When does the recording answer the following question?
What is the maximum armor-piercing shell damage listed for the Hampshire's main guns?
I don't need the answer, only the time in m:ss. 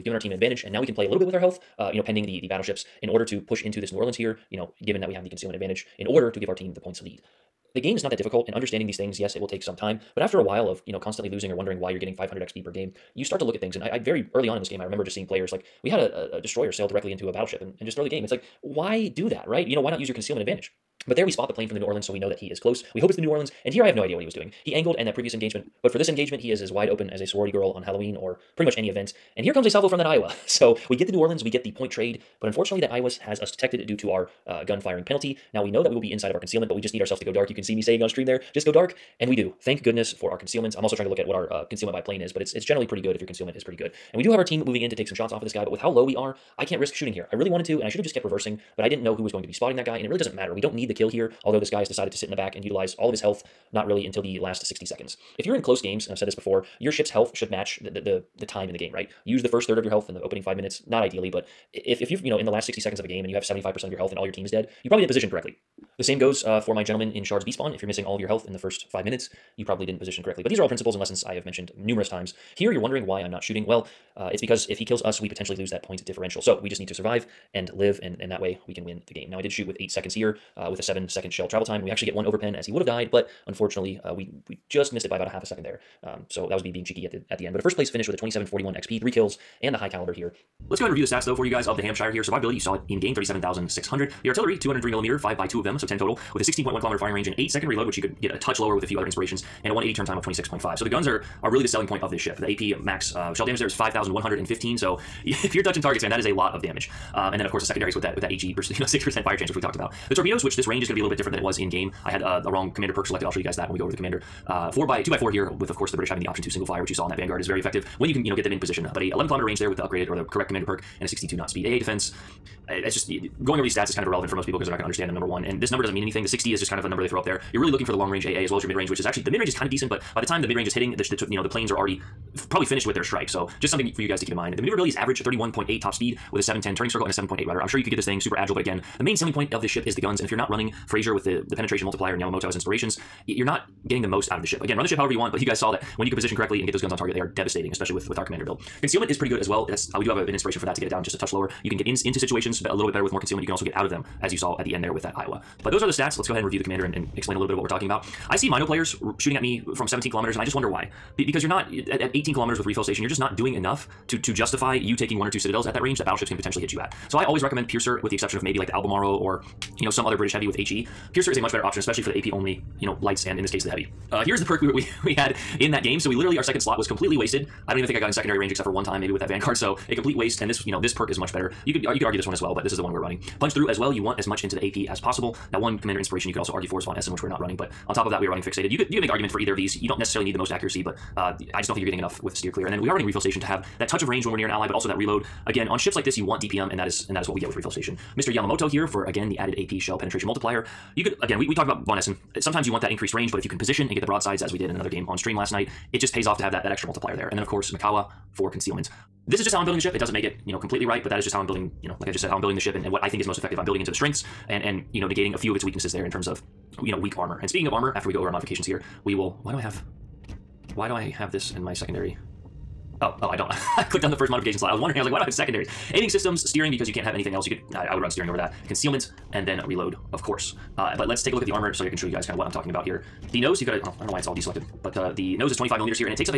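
1:43.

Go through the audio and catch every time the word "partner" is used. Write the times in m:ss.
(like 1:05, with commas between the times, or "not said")
not said.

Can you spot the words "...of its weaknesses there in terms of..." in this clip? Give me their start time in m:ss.
3:35.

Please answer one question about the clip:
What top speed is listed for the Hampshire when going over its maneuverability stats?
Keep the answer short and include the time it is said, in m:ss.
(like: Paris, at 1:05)
31.8, at 2:15.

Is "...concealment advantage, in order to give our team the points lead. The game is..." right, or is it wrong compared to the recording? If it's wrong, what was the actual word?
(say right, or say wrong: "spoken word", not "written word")
right.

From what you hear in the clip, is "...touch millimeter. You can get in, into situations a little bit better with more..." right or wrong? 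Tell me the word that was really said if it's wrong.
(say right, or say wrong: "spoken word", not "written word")
wrong: "lower", not "millimeter".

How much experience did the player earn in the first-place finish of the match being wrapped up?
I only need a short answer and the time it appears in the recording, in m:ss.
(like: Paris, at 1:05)
2741, at 1:28.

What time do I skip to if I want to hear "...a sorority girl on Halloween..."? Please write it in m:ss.
0:27.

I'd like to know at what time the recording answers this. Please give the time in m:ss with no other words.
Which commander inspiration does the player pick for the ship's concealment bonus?
3:27.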